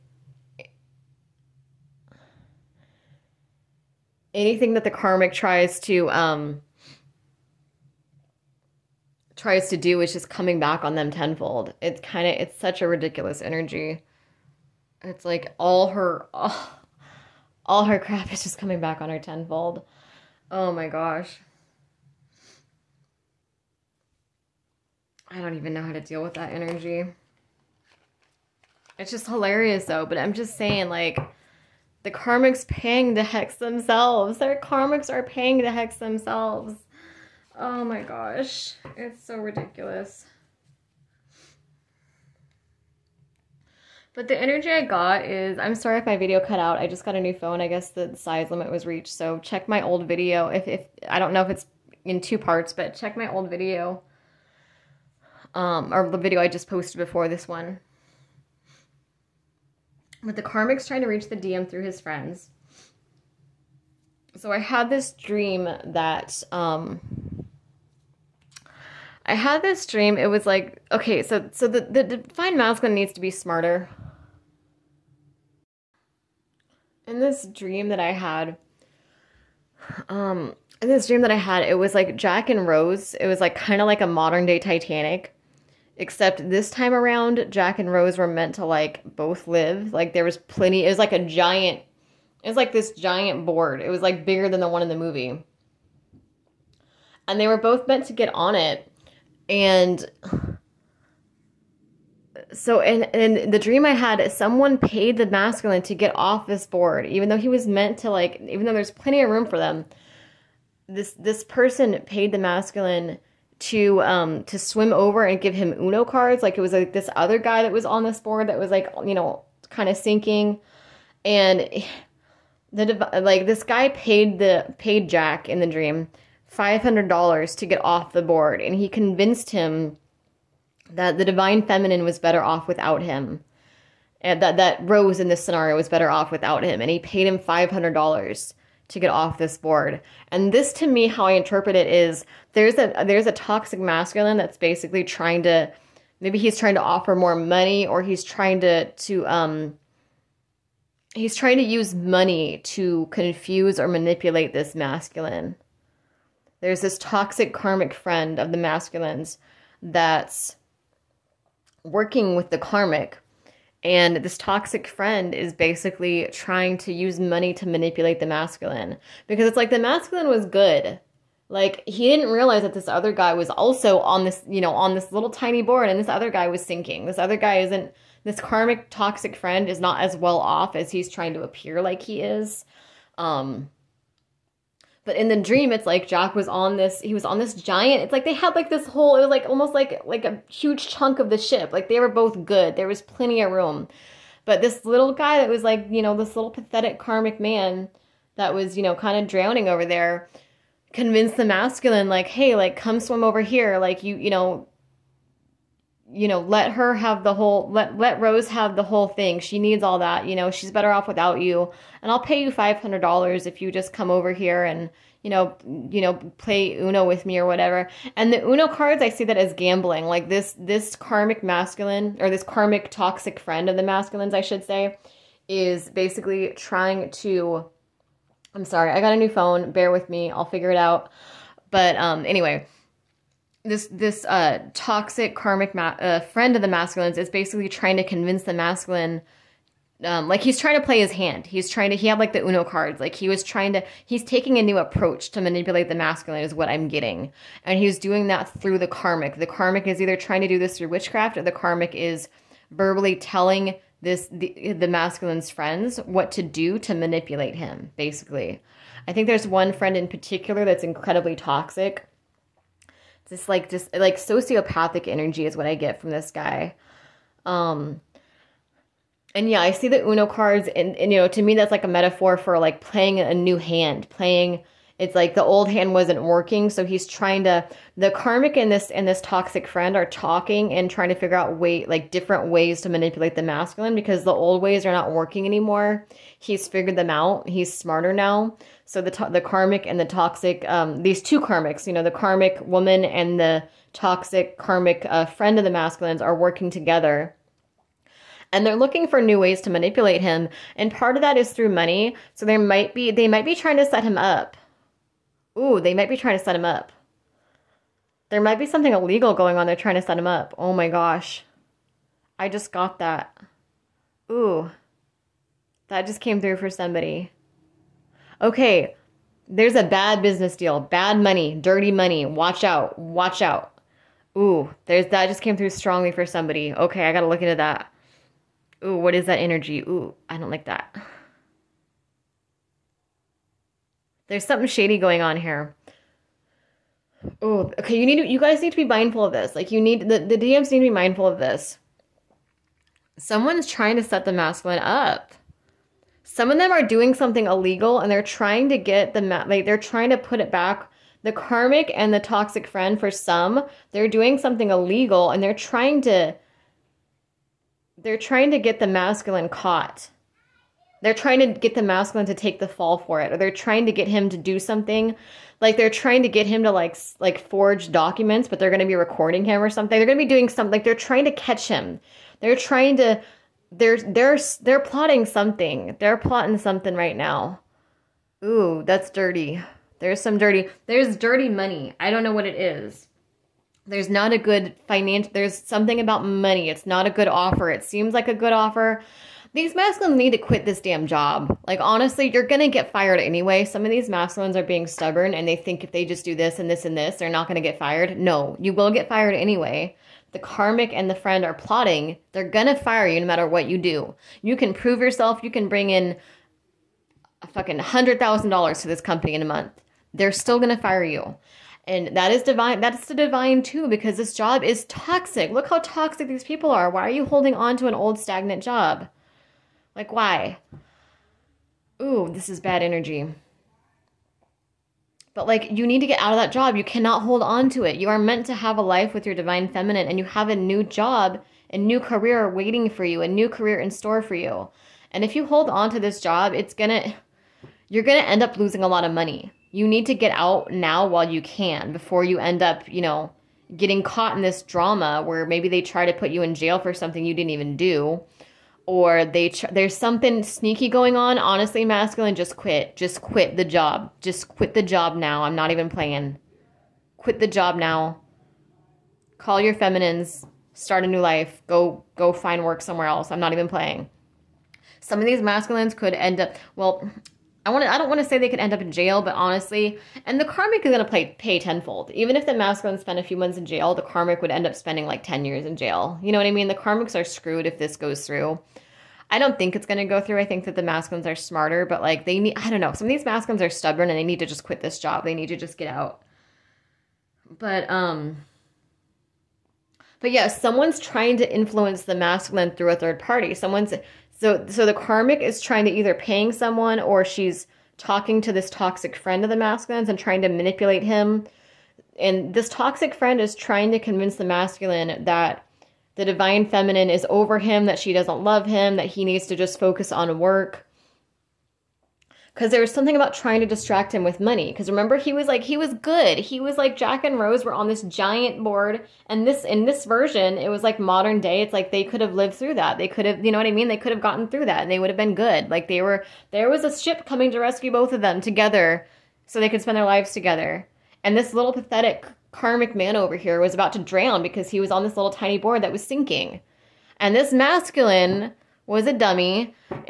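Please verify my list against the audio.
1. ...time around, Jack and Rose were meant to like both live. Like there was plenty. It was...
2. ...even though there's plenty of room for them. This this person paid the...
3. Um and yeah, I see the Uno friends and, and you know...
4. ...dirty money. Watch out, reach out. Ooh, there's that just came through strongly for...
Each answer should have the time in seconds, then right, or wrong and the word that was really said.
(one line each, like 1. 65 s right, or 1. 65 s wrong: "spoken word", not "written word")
1. 86 s right
2. 108 s right
3. 267 s wrong: "cards", not "friends"
4. 321 s wrong: "watch", not "reach".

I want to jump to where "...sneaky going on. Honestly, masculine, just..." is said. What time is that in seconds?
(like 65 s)
450 s.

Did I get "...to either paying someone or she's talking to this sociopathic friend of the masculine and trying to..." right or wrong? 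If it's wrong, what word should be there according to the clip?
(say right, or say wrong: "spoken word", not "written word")
wrong: "toxic", not "sociopathic".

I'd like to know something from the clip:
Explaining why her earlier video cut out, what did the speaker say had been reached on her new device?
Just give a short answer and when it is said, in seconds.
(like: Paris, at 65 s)
The size limit, at 48 s.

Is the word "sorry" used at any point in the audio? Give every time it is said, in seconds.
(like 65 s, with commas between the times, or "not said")
45 s, 228 s.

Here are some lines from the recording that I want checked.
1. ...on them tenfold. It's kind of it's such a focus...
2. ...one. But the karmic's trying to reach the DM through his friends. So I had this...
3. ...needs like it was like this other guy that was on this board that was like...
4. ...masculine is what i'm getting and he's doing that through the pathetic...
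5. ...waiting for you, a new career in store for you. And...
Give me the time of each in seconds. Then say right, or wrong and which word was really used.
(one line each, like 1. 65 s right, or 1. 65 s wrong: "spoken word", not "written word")
1. 10 s wrong: "ridiculous", not "focus"
2. 57 s right
3. 116 s wrong: "cards", not "needs"
4. 245 s wrong: "karmic", not "pathetic"
5. 432 s right.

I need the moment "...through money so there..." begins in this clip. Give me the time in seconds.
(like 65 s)
301 s.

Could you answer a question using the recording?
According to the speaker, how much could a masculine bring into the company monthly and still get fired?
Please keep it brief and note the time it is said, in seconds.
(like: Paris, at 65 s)
$100,000, at 407 s.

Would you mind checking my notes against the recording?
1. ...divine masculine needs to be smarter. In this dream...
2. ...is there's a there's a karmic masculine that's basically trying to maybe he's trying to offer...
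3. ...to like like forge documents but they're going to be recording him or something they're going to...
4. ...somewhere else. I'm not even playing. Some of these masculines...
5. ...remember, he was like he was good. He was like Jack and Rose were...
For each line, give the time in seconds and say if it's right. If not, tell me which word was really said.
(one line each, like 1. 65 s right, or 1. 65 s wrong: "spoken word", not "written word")
1. 72 s right
2. 141 s wrong: "toxic", not "karmic"
3. 366 s right
4. 462 s right
5. 514 s right.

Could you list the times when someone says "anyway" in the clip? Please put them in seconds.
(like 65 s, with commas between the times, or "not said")
232 s, 393 s, 399 s.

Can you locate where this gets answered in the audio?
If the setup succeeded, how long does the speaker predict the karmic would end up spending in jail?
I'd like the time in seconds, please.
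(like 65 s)
475 s.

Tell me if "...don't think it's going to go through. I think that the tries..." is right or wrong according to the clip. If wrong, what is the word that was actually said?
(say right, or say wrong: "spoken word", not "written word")
wrong: "masculines", not "tries".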